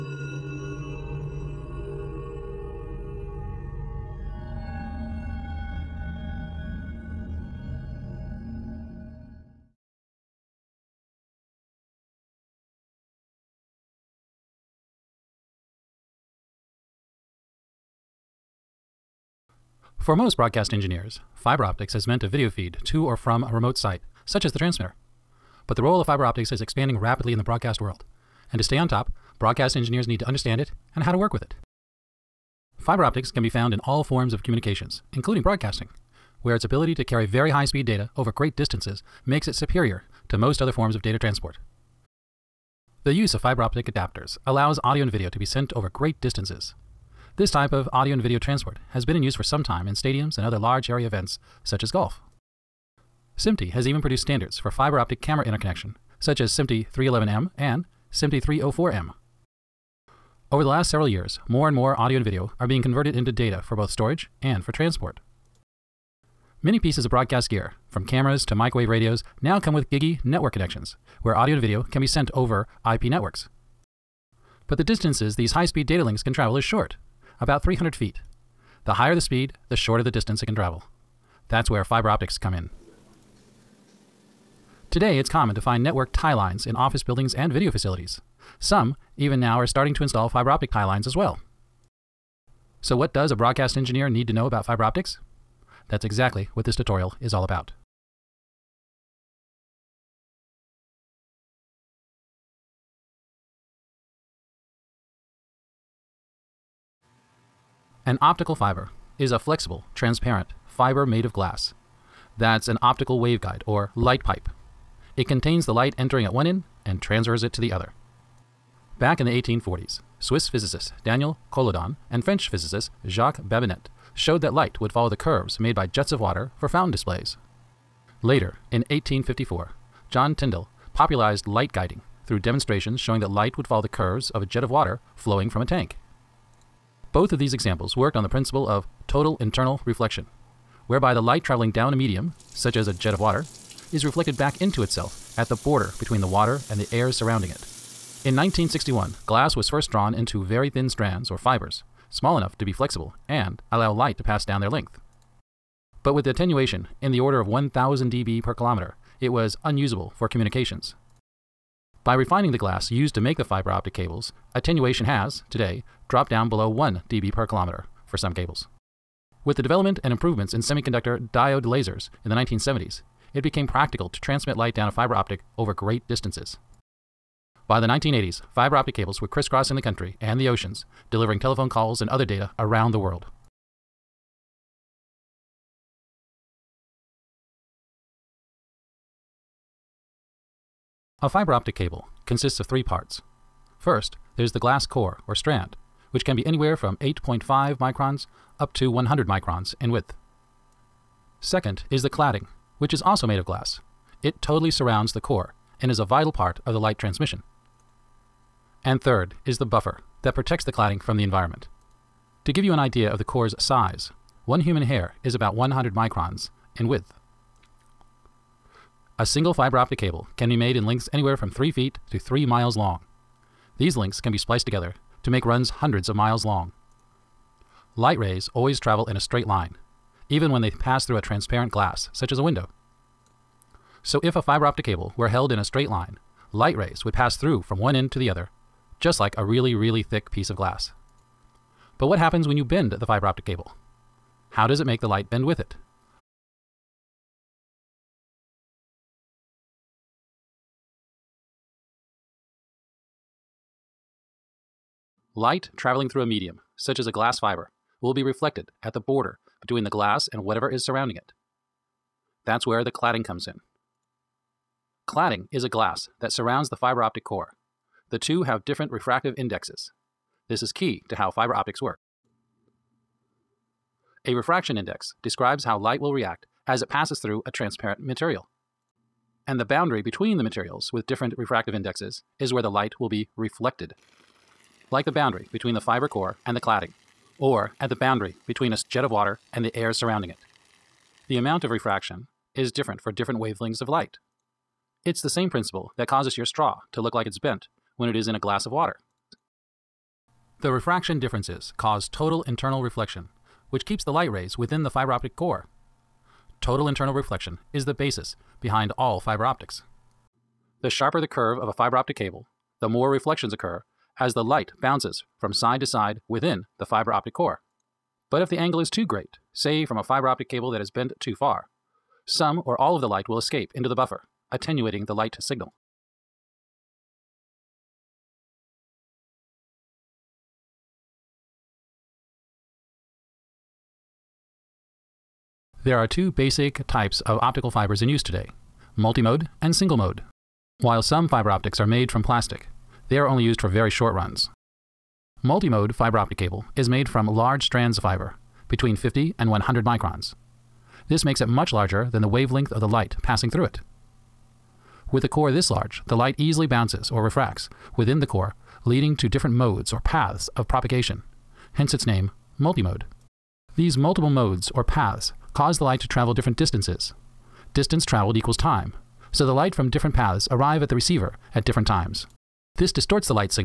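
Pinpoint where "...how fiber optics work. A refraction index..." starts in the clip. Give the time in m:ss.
4:31.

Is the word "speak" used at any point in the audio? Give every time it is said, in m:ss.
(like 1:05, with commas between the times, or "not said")
not said.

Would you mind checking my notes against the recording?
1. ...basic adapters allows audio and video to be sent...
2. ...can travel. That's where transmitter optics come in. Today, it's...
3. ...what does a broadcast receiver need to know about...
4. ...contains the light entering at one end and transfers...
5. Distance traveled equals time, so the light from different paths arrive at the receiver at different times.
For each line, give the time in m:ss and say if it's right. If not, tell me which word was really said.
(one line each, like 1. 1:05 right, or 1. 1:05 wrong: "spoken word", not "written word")
1. 0:43 wrong: "optic", not "basic"
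2. 1:20 wrong: "fiber", not "transmitter"
3. 1:32 wrong: "engineer", not "receiver"
4. 1:55 right
5. 6:07 right.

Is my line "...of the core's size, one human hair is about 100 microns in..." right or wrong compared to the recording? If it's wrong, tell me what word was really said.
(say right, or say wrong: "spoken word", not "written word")
right.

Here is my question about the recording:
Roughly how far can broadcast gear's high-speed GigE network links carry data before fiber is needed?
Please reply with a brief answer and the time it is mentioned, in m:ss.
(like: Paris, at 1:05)
300 feet, at 1:17.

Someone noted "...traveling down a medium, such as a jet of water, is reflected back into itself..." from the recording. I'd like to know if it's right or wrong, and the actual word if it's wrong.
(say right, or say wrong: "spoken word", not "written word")
right.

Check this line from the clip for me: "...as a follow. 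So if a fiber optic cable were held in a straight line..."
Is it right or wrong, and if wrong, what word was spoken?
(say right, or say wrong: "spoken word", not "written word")
wrong: "window", not "follow".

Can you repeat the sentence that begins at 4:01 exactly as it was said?
But what happens when you bend the fiber optic cable?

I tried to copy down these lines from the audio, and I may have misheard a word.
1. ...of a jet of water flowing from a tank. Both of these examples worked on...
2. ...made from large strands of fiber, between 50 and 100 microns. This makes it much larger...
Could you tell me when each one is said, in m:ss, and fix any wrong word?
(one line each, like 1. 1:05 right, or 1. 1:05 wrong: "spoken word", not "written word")
1. 2:14 right
2. 5:46 right.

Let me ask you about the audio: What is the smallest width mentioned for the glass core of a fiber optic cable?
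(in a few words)
8.5 microns.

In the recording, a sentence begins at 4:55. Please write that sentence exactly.
It's the same principle that causes your straw to look like it's bent when it is in a glass of water.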